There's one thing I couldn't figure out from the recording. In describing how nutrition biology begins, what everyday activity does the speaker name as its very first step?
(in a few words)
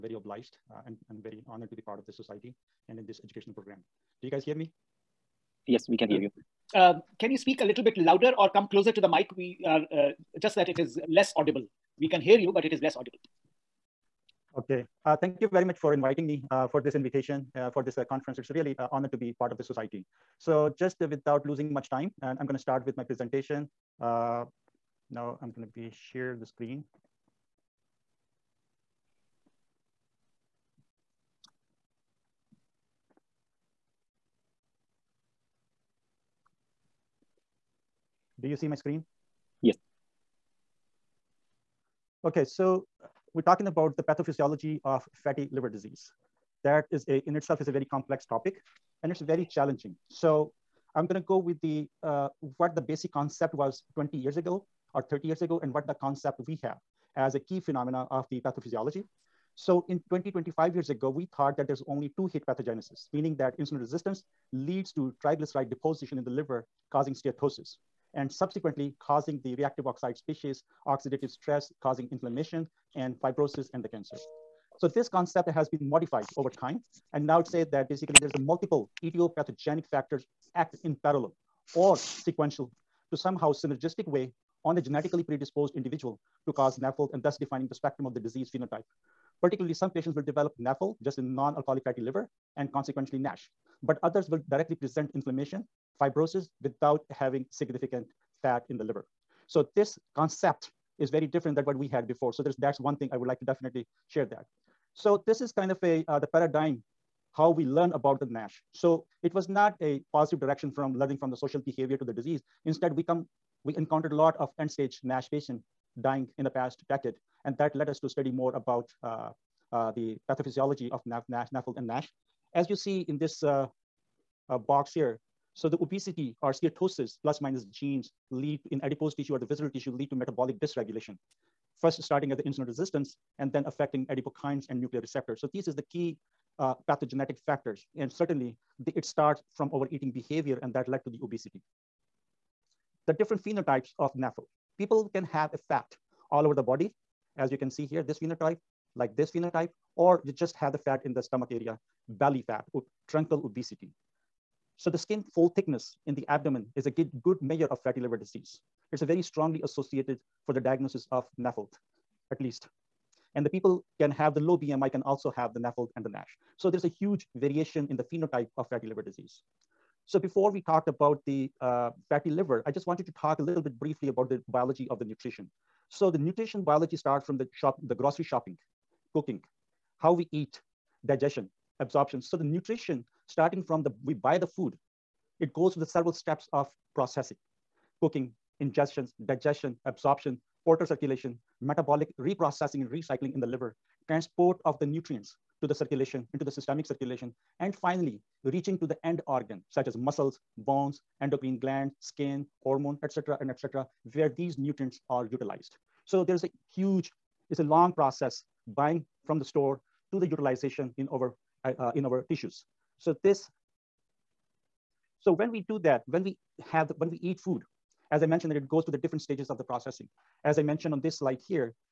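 Grocery shopping.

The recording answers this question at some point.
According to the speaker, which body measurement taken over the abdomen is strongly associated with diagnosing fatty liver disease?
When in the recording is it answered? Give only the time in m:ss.
2:34.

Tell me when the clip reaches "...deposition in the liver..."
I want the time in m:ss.
1:05.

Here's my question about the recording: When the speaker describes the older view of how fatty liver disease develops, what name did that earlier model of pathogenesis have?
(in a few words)
two hit pathogenesis.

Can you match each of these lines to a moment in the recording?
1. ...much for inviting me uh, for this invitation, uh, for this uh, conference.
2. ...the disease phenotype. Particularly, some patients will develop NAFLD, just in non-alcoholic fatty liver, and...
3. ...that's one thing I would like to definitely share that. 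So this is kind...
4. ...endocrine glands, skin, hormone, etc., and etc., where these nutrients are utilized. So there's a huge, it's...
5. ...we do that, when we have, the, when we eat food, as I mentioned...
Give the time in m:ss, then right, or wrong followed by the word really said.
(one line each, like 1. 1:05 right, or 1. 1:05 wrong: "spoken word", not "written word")
1. 0:15 right
2. 1:28 right
3. 1:42 right
4. 3:21 right
5. 3:35 right.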